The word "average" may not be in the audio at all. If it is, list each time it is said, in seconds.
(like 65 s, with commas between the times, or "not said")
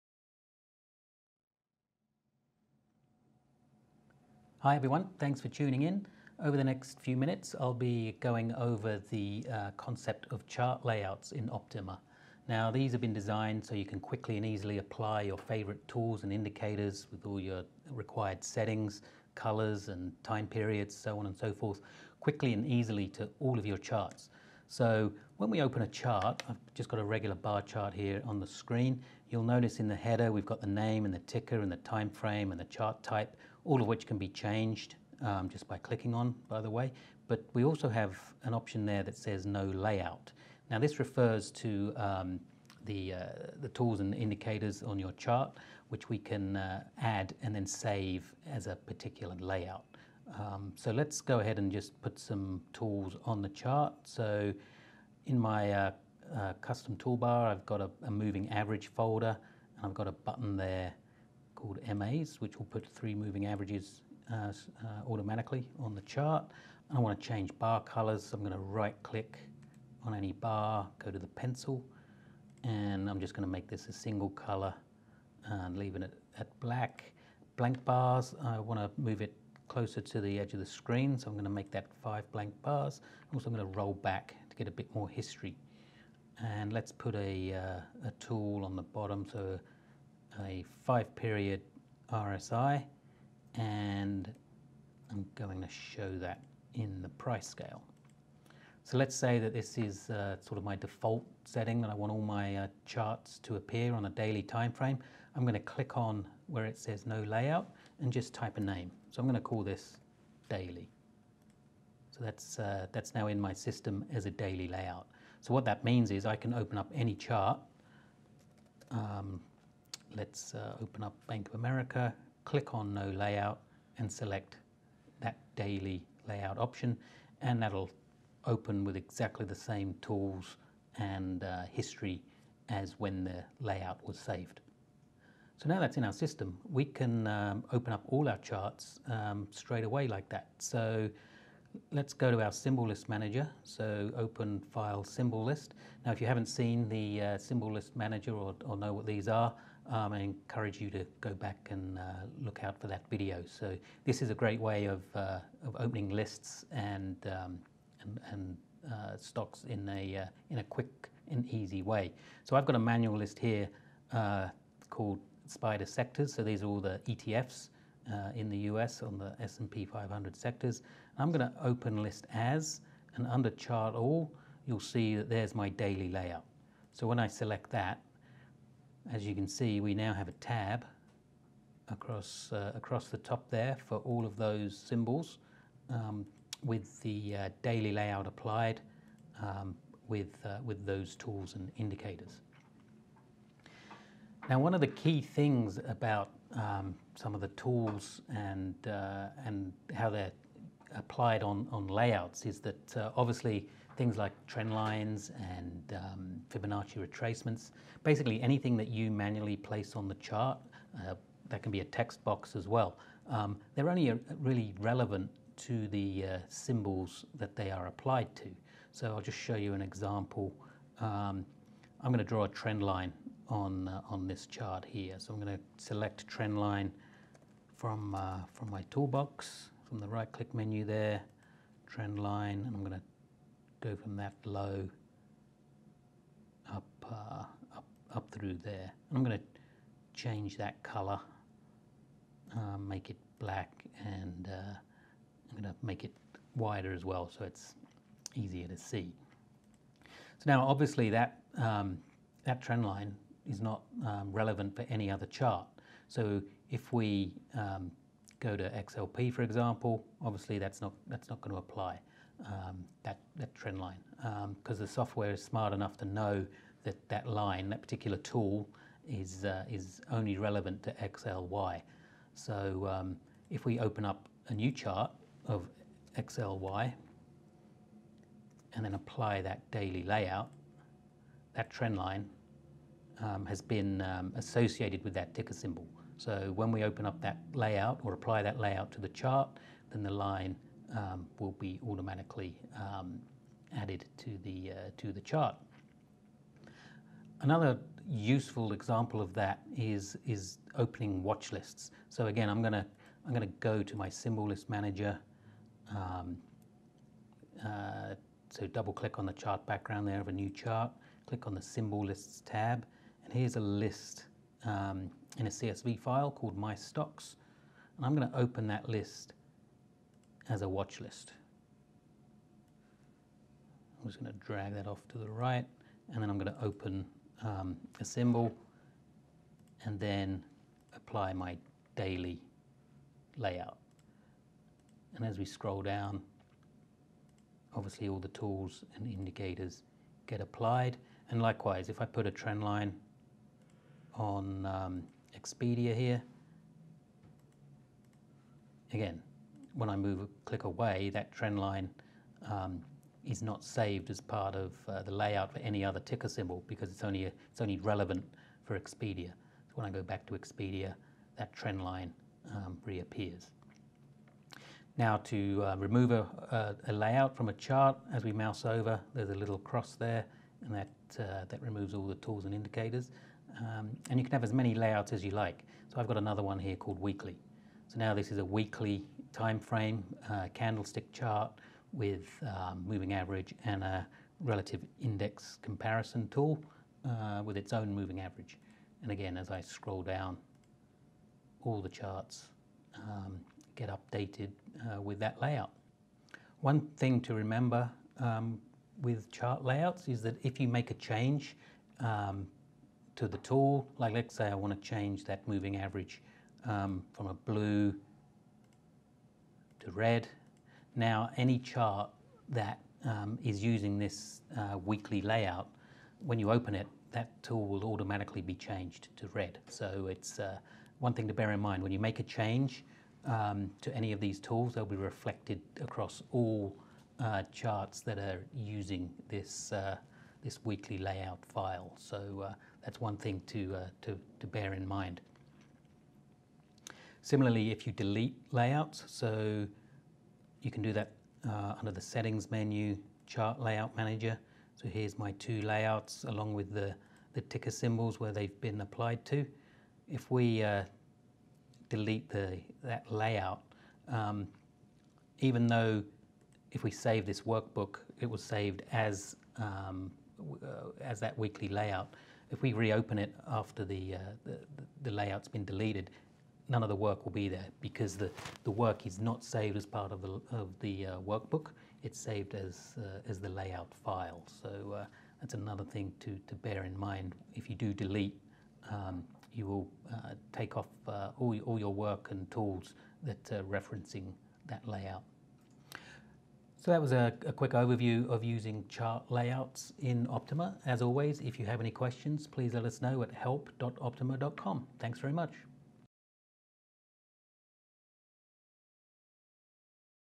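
58 s, 63 s, 383 s, 388 s, 405 s.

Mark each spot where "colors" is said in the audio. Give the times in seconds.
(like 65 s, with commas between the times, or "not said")
19 s, 67 s, 74 s, 240 s.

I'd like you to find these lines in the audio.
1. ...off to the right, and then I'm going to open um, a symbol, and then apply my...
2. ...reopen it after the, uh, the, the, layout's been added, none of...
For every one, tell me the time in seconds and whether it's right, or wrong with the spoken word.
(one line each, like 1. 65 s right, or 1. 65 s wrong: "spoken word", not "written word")
1. 324 s right
2. 462 s wrong: "deleted", not "added".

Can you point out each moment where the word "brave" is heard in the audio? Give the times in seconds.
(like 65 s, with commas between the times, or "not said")
not said.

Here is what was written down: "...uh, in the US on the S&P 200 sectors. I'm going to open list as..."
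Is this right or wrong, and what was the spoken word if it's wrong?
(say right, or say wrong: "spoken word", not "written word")
wrong: "500", not "200".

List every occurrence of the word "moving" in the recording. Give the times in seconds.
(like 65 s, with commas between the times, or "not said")
58 s, 63 s, 382 s, 387 s, 405 s.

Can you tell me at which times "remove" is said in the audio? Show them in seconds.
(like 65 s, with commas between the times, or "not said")
365 s, 371 s.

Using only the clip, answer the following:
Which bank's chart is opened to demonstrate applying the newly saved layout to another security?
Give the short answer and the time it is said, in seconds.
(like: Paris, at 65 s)
Bank of America, at 121 s.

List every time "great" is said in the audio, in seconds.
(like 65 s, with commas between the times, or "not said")
154 s.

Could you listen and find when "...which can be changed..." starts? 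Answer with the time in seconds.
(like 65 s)
33 s.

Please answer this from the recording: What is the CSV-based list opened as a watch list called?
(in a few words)
My Stocks.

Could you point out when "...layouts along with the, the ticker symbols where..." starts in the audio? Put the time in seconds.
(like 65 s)
445 s.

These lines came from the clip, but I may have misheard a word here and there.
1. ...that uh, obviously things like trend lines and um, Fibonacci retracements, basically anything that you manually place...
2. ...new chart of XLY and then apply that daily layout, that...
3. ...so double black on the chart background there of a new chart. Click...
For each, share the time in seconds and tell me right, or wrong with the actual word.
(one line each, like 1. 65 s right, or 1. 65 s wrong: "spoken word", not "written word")
1. 202 s right
2. 274 s right
3. 308 s wrong: "click", not "black".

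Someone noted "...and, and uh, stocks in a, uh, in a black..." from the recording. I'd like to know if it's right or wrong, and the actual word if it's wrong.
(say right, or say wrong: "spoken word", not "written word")
wrong: "quick", not "black".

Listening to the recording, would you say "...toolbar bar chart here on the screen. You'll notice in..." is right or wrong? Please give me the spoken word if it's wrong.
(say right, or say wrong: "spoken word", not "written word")
wrong: "regular", not "toolbar".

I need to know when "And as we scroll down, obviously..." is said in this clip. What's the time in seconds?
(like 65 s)
335 s.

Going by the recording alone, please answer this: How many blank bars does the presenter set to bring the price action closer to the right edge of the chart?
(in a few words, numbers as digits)
5.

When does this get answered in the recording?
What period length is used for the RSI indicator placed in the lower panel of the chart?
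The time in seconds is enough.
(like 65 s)
90 s.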